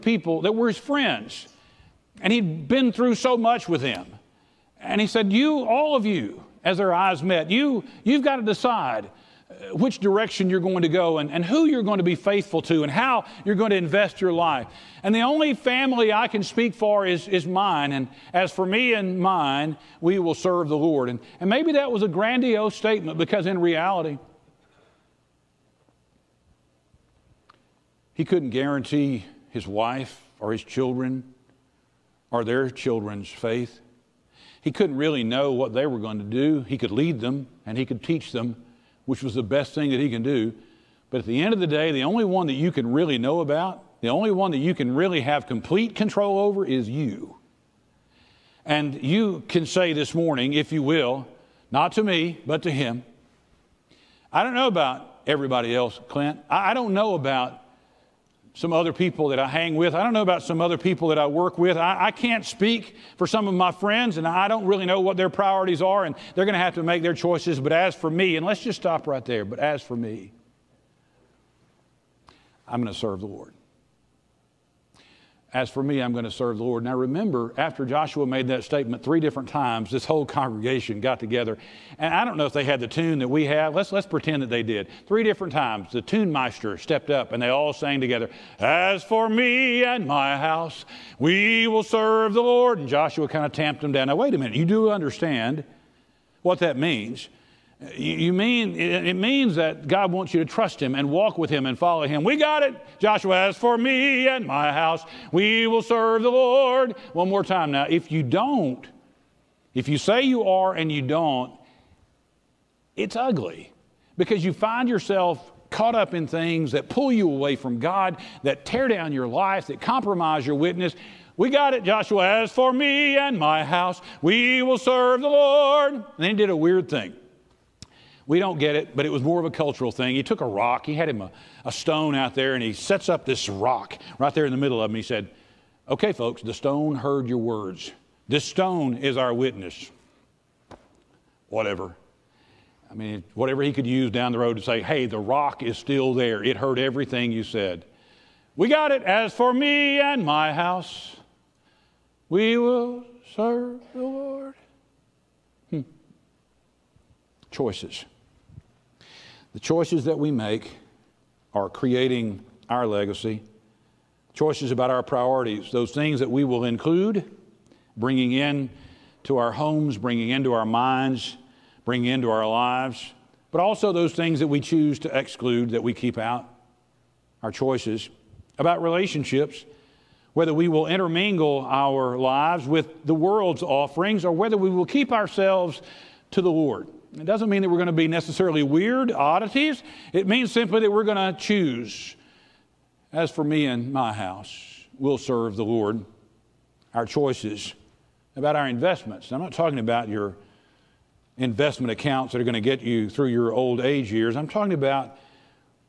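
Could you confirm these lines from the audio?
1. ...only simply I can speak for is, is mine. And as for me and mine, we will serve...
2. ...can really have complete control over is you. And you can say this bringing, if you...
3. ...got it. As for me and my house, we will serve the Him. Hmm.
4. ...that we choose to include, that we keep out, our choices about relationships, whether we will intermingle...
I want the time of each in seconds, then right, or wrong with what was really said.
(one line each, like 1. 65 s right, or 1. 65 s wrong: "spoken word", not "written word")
1. 15 s wrong: "family", not "simply"
2. 44 s wrong: "morning", not "bringing"
3. 148 s wrong: "Lord", not "Him"
4. 174 s wrong: "exclude", not "include".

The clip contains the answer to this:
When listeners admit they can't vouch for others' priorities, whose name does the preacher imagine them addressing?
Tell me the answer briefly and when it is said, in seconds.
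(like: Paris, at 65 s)
Clint, at 56 s.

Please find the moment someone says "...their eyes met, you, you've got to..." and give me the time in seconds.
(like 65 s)
6 s.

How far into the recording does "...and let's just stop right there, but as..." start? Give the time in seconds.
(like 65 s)
68 s.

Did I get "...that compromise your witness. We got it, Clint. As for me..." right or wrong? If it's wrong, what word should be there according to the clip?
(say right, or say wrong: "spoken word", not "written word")
wrong: "Joshua", not "Clint".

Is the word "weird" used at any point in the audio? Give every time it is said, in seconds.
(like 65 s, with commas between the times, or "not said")
126 s, 188 s.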